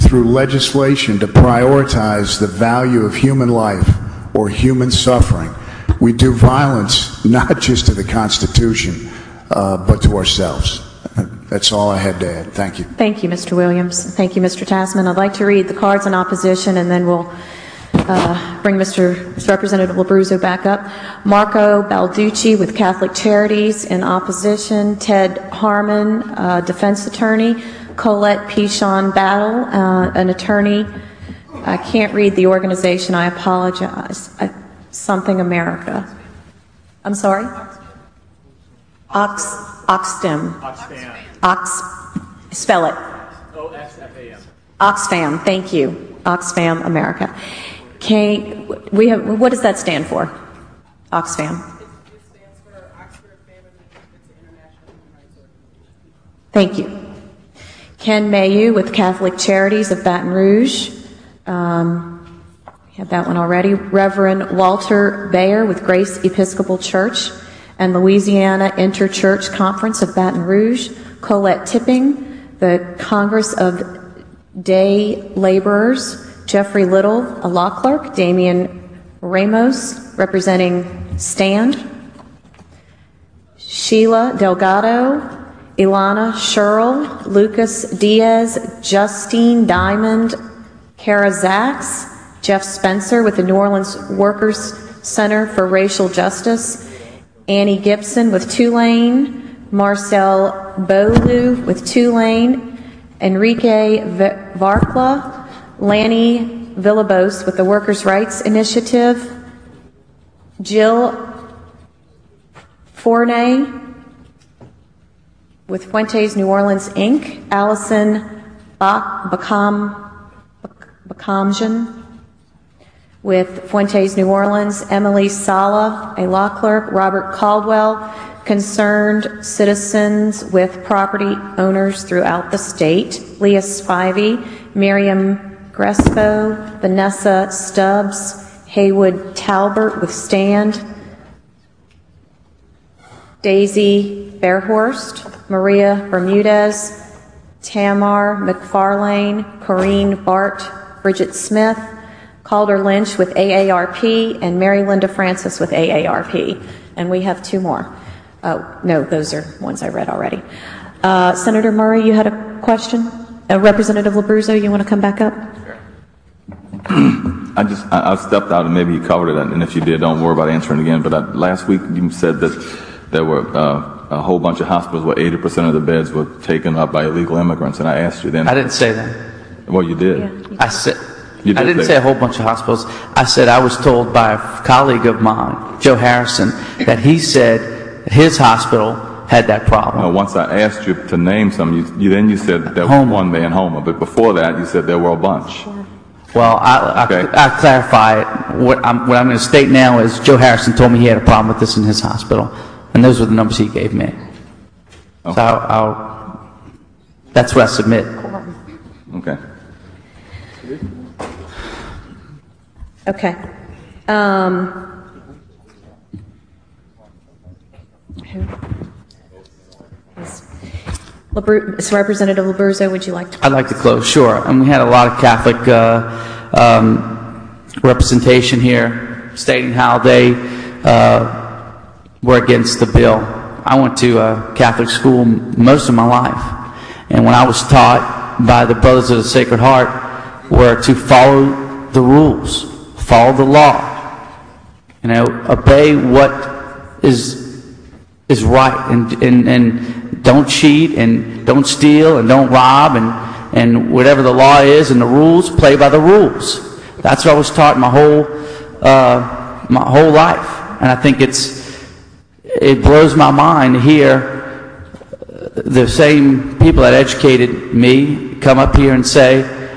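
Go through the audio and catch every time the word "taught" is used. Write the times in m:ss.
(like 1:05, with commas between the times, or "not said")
3:57, 4:17.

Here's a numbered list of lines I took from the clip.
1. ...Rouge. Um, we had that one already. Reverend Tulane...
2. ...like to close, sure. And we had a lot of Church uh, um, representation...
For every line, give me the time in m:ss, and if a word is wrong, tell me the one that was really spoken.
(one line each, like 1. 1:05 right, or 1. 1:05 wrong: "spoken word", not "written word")
1. 1:00 wrong: "Walter", not "Tulane"
2. 3:43 wrong: "Catholic", not "Church".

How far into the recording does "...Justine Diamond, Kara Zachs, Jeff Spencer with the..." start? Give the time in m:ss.
1:28.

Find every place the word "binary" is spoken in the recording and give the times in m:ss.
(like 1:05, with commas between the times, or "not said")
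not said.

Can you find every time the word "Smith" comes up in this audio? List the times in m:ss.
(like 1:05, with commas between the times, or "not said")
2:31.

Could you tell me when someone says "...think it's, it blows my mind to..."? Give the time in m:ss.
4:20.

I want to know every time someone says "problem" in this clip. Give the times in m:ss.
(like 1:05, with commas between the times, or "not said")
3:09, 3:21.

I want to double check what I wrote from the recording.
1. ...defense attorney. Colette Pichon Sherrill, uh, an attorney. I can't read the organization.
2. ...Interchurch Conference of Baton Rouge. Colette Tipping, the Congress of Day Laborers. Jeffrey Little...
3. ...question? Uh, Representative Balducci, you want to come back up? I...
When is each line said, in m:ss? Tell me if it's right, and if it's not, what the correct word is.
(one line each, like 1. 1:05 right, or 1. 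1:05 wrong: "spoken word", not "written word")
1. 0:26 wrong: "Battle", not "Sherrill"
2. 1:08 right
3. 2:42 wrong: "Labruzzo", not "Balducci".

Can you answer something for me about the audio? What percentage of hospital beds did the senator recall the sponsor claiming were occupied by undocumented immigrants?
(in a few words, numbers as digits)
80%.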